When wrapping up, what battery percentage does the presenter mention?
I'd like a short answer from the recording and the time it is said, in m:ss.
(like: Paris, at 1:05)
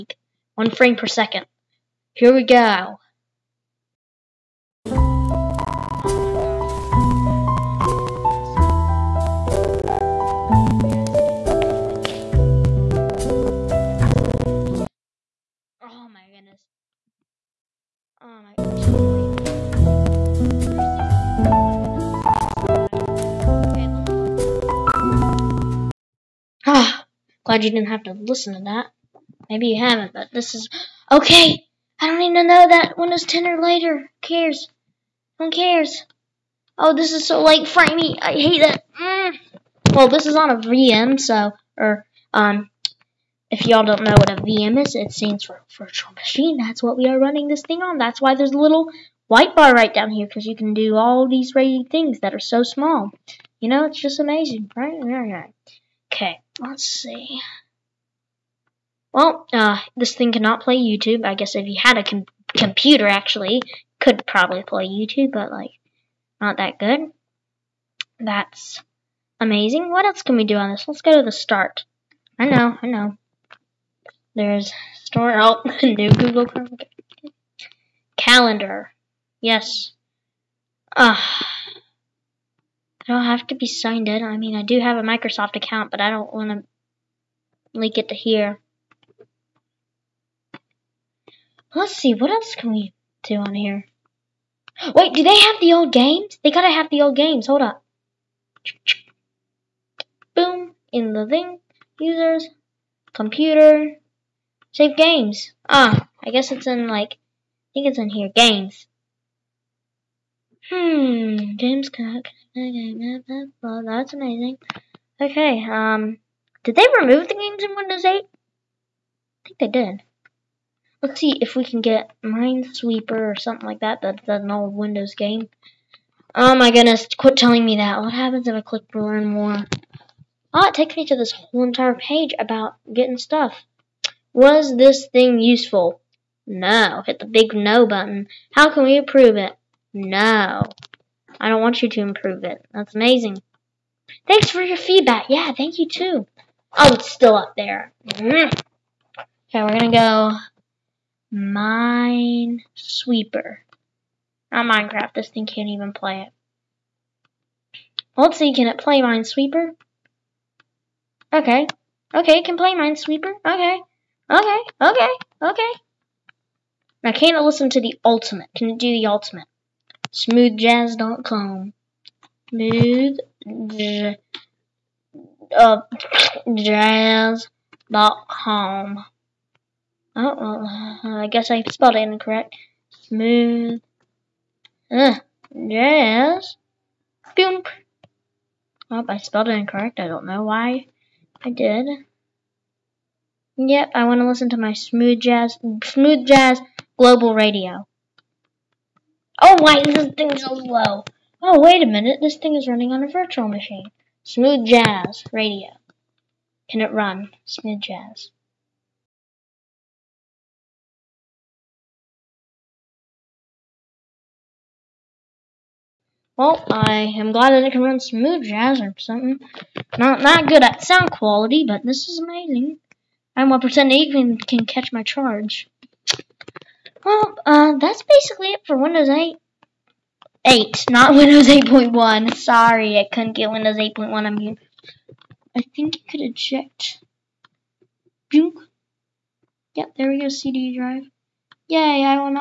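1%, at 3:43.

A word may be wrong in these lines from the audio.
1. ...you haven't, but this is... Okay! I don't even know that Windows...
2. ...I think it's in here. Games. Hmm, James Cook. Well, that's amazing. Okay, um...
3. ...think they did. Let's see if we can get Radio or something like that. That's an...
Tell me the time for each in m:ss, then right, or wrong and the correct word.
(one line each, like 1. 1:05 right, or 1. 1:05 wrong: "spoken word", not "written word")
1. 0:29 right
2. 1:47 right
3. 1:59 wrong: "Minesweeper", not "Radio".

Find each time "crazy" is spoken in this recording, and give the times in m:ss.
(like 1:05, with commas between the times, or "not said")
0:51.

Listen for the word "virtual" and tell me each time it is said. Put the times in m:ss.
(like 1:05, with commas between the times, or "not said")
0:45, 3:23.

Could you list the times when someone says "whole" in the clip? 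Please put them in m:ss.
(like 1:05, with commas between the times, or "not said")
2:11.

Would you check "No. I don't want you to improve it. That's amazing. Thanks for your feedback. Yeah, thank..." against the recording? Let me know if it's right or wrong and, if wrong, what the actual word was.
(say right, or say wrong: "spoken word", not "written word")
right.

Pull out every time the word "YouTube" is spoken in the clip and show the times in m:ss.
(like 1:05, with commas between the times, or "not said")
1:00, 1:04.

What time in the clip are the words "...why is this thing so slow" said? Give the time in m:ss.
3:19.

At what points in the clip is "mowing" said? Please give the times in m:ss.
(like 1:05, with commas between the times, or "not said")
not said.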